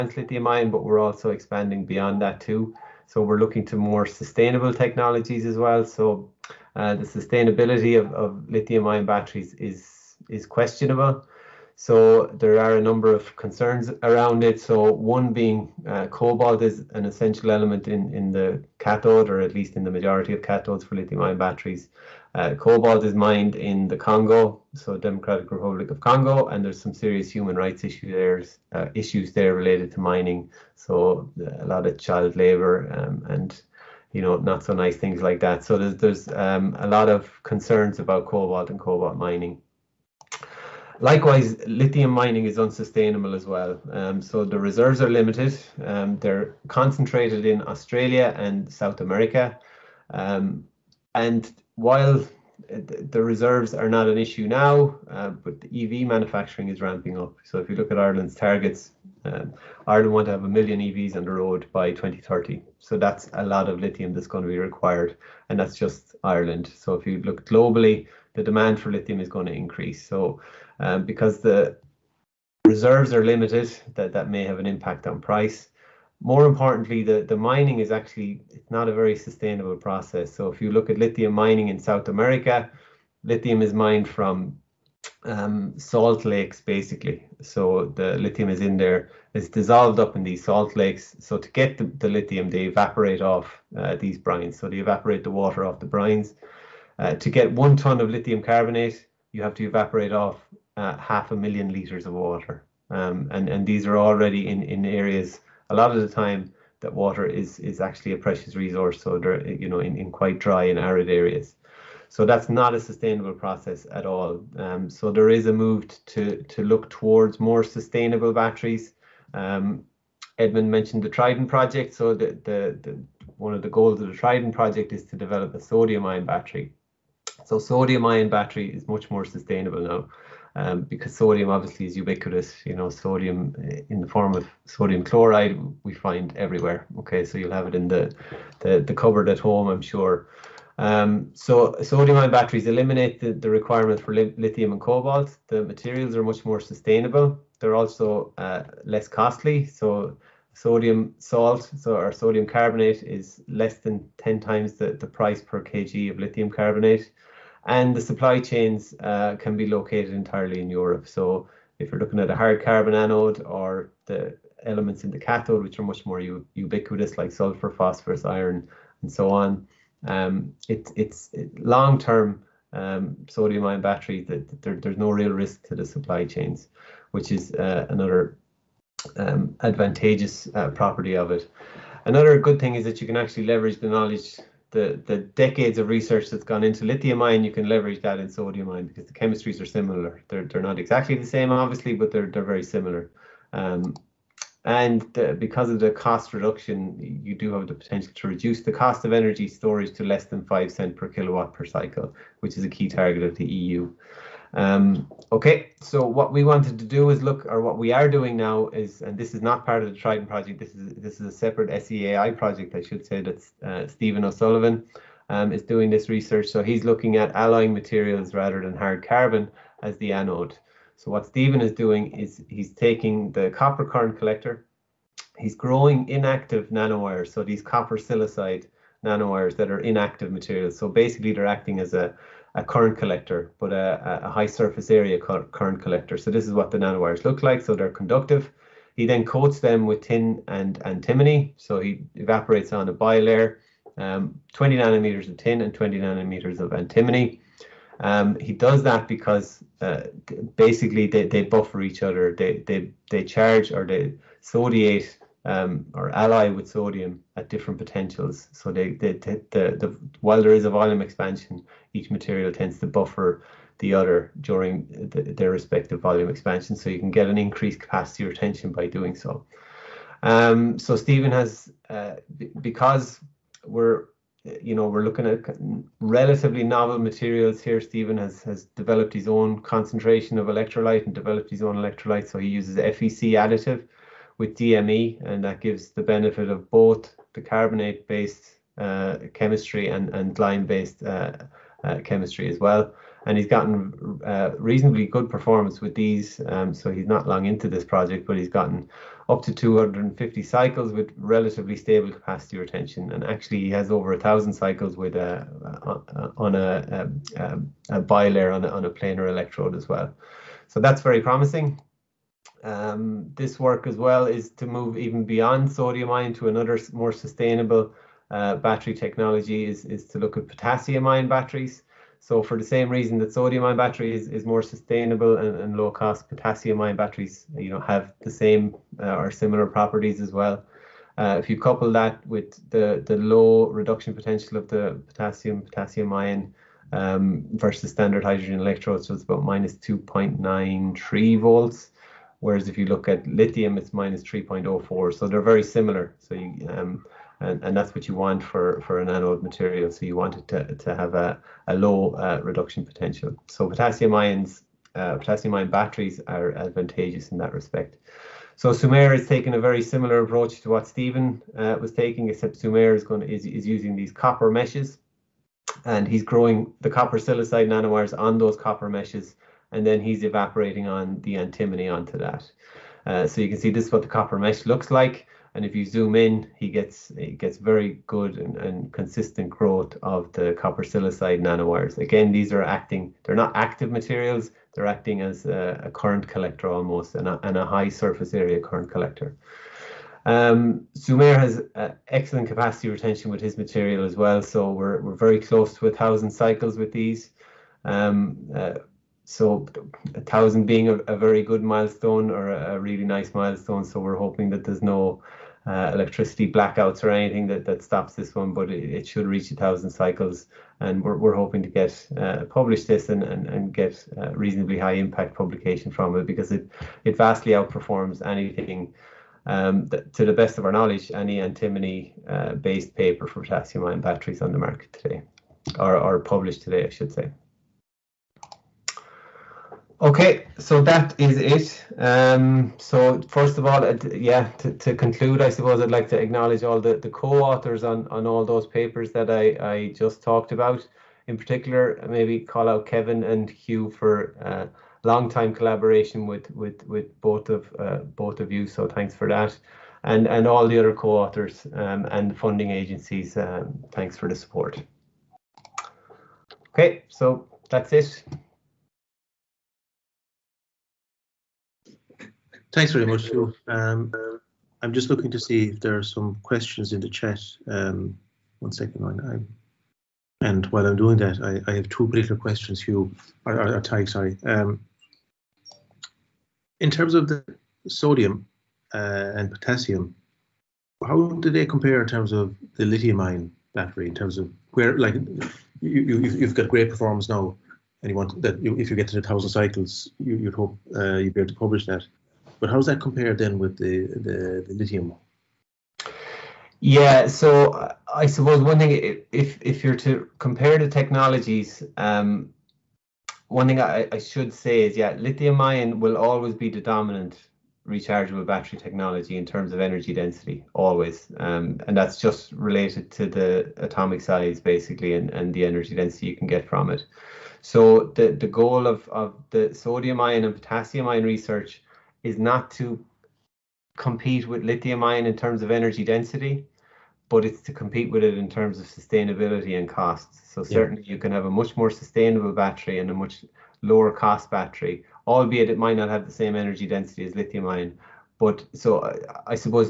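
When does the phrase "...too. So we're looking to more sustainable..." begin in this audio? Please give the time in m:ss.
0:02.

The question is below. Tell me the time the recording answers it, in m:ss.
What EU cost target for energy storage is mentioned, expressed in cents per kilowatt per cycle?
3:20.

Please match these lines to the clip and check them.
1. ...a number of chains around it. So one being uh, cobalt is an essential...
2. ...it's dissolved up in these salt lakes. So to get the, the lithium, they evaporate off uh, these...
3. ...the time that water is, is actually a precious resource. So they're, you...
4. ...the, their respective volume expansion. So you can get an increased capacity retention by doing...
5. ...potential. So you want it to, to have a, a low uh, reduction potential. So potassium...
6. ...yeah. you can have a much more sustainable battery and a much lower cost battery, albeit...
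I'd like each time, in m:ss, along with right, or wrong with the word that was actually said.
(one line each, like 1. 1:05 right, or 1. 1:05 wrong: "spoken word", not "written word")
1. 0:12 wrong: "concerns", not "chains"
2. 1:29 right
3. 1:46 right
4. 4:24 right
5. 5:49 wrong: "material", not "potential"
6. 8:51 right.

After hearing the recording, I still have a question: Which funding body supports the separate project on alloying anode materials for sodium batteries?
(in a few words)
SEAI.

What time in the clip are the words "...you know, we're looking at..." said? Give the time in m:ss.
4:34.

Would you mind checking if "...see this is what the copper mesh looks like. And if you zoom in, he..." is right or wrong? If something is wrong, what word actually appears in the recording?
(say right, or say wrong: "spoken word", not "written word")
right.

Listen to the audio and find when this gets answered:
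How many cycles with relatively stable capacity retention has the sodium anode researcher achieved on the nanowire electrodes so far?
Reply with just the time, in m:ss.
4:59.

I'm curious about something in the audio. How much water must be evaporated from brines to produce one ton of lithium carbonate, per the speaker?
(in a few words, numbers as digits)
half a million litres.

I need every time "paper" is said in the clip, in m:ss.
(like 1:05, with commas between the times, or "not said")
7:02, 7:18.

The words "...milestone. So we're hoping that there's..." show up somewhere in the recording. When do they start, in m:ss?
6:43.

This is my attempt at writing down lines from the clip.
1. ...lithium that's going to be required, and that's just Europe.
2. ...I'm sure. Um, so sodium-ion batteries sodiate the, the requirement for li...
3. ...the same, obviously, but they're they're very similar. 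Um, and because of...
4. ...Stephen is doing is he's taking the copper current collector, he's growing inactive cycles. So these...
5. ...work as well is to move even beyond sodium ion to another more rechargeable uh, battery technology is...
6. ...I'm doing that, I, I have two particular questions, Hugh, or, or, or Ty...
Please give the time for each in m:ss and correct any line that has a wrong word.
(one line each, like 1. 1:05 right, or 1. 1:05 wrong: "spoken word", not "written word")
1. 1:03 wrong: "Ireland", not "Europe"
2. 2:19 wrong: "eliminate", not "sodiate"
3. 3:11 right
4. 3:41 wrong: "nanowires", not "cycles"
5. 5:13 wrong: "sustainable", not "rechargeable"
6. 7:50 right.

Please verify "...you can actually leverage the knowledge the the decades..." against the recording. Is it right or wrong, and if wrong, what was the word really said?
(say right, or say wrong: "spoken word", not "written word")
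right.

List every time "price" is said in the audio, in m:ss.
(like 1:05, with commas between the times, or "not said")
1:15, 2:35.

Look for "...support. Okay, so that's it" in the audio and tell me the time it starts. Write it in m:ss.
7:34.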